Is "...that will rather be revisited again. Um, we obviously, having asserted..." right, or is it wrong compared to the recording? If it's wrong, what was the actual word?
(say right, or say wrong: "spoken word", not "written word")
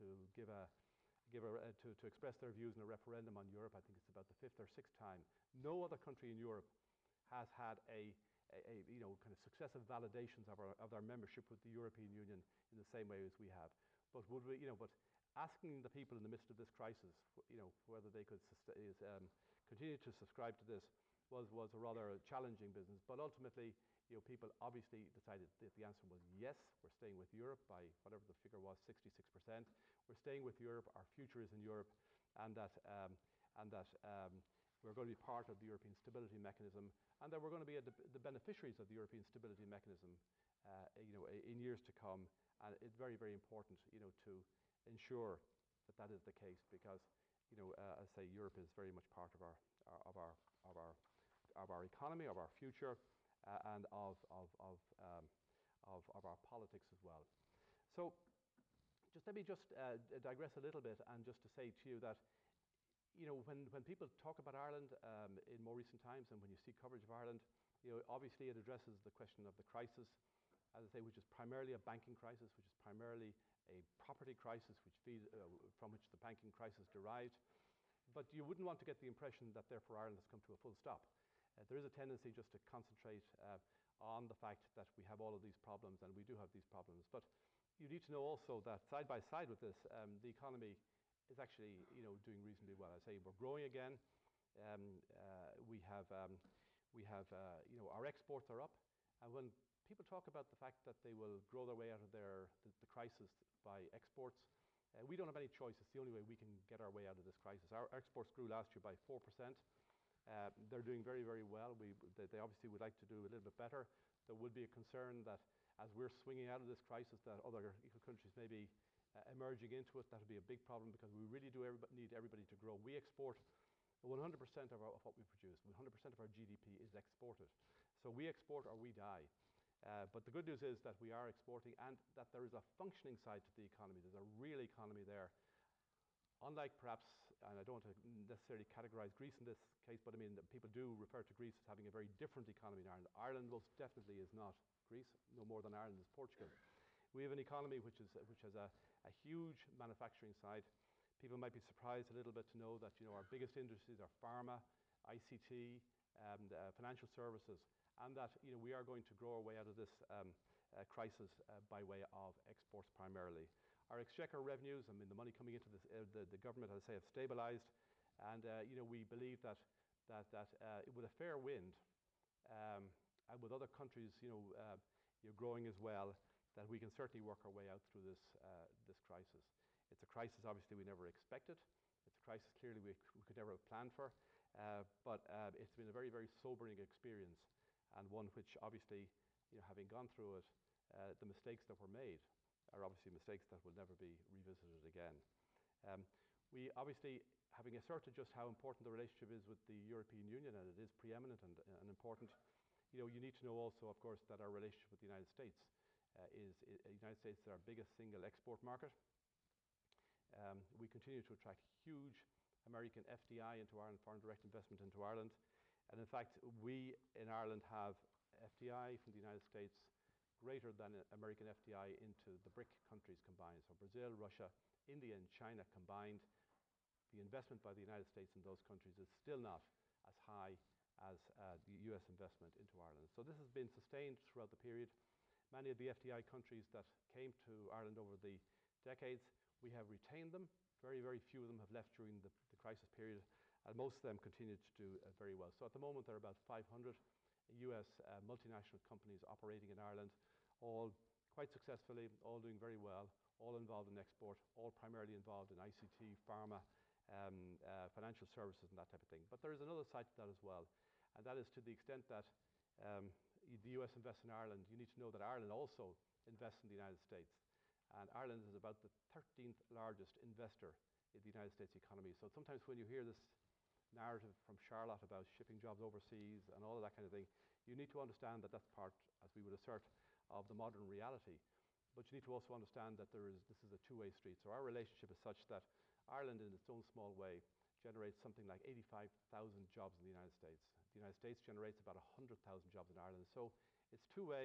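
wrong: "never", not "rather".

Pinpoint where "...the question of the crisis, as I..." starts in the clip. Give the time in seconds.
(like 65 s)
68 s.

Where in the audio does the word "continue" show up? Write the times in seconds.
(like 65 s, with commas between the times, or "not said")
19 s, 210 s, 244 s.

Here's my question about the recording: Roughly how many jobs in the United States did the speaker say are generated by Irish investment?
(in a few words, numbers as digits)
85,000.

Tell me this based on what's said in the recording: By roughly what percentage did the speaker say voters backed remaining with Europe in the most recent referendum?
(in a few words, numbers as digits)
66%.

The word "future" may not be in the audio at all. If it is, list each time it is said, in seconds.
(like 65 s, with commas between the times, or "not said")
31 s, 52 s.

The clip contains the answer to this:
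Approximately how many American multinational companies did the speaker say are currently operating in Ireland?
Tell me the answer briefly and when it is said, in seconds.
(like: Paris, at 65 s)
500, at 246 s.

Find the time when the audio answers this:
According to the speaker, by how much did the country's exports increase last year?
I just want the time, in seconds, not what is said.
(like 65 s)
108 s.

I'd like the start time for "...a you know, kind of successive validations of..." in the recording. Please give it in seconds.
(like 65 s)
8 s.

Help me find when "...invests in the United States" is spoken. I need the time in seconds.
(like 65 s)
266 s.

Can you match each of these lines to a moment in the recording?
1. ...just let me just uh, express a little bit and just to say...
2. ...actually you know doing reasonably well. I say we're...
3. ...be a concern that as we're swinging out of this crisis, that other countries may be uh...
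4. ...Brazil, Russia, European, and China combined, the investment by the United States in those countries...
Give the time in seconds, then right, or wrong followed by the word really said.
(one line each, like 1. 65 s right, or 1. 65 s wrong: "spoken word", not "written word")
1. 59 s wrong: "digress", not "express"
2. 91 s right
3. 114 s right
4. 223 s wrong: "India", not "European".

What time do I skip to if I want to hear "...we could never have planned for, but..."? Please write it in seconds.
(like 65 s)
183 s.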